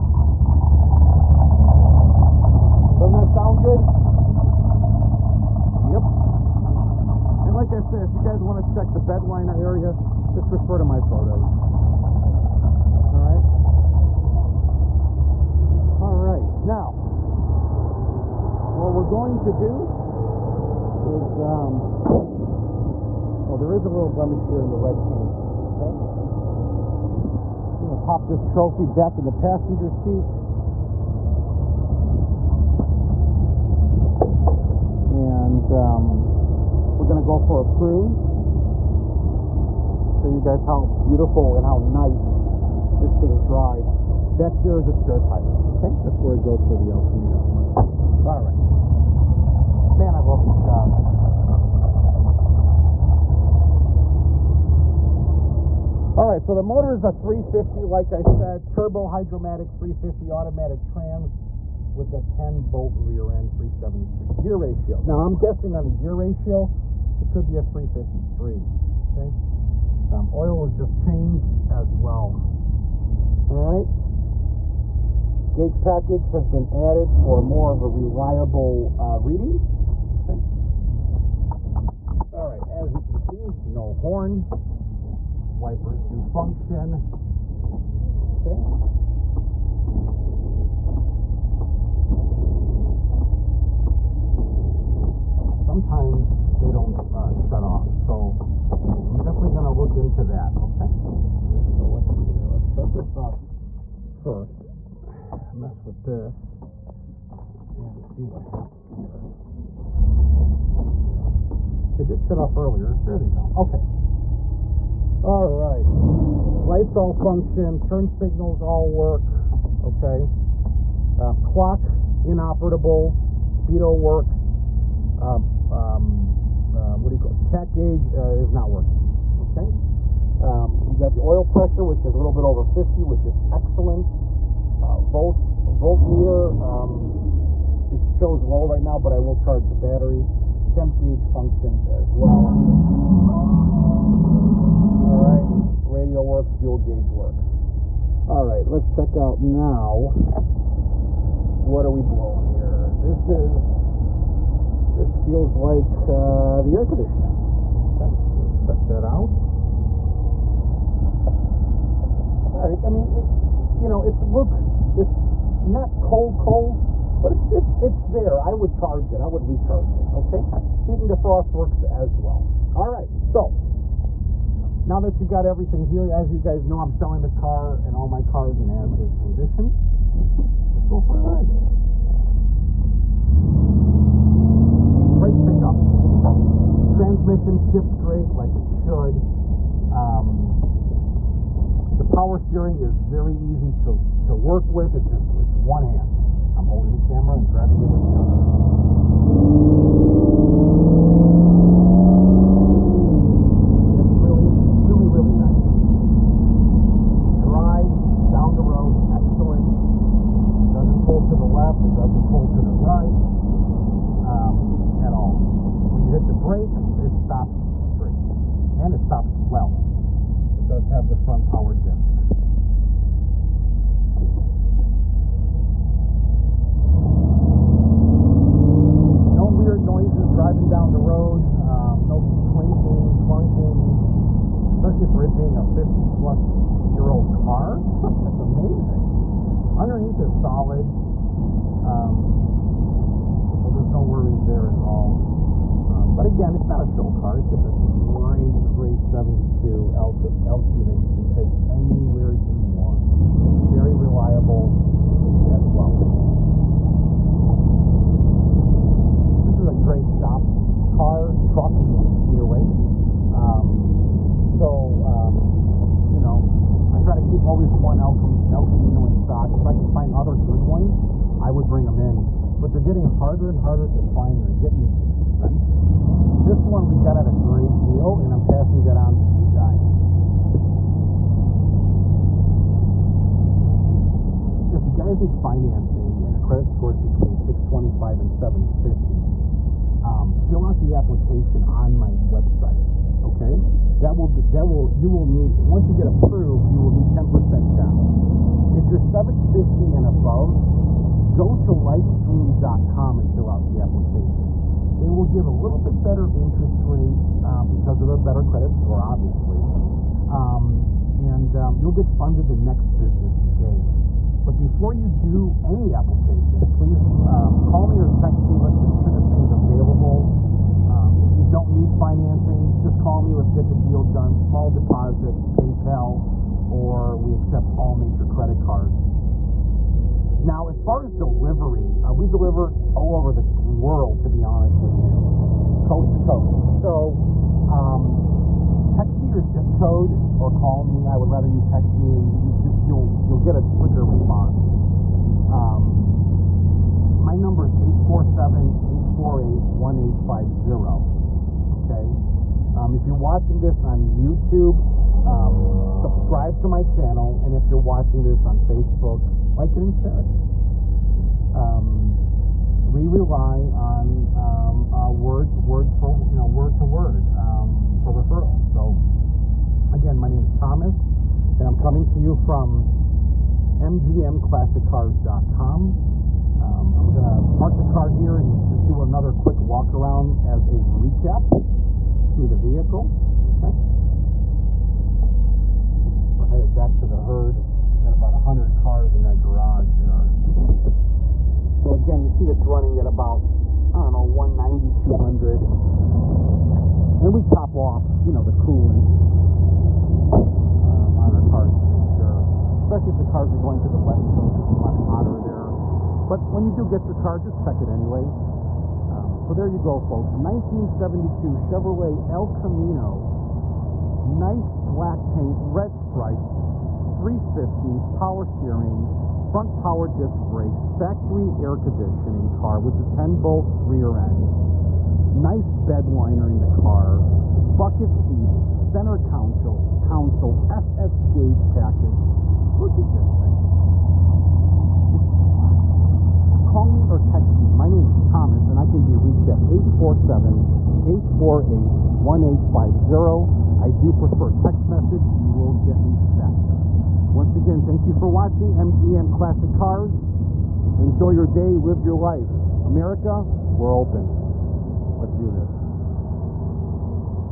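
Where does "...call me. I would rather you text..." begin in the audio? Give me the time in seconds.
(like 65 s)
340 s.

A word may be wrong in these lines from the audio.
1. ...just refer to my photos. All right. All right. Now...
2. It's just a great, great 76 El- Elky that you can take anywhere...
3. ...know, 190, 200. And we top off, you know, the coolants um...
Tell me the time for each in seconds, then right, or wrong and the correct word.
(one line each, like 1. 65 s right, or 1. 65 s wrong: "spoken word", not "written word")
1. 10 s right
2. 247 s wrong: "72", not "76"
3. 394 s right.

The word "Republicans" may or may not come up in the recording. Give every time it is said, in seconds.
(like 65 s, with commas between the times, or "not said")
not said.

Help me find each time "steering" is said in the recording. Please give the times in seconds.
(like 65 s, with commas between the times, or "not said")
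192 s, 418 s.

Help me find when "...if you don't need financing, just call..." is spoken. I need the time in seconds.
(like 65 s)
321 s.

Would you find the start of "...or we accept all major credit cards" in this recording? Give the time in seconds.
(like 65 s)
326 s.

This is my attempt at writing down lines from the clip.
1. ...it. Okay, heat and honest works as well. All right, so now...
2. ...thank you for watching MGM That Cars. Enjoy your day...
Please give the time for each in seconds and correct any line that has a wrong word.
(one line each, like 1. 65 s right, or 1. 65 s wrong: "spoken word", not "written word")
1. 169 s wrong: "defrost", not "honest"
2. 447 s wrong: "Classic", not "That".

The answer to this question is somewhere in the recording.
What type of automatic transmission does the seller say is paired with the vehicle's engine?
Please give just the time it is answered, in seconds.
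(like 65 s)
58 s.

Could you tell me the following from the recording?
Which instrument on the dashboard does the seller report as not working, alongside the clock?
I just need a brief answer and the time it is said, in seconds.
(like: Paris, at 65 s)
Tach gauge, at 127 s.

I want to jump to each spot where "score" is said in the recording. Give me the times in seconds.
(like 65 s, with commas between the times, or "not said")
286 s, 308 s.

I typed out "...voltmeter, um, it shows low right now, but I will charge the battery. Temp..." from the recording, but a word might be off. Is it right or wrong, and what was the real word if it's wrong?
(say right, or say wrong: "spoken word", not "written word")
right.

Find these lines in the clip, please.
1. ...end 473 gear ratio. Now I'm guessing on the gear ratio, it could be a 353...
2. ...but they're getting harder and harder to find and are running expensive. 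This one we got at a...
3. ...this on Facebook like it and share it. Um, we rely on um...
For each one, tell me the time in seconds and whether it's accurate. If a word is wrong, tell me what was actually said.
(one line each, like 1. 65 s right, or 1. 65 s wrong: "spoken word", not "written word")
1. 63 s wrong: "373", not "473"
2. 272 s wrong: "getting", not "running"
3. 358 s right.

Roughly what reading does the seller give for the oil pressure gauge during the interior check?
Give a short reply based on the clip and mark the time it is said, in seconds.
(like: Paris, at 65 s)
A little over 50, at 132 s.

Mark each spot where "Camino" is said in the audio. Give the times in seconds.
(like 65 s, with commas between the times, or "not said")
47 s, 268 s, 412 s.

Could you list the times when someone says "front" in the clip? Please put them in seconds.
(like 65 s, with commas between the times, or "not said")
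221 s, 419 s.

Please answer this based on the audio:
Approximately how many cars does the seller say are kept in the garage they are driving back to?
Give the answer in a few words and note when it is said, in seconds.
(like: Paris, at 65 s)
About 100, at 388 s.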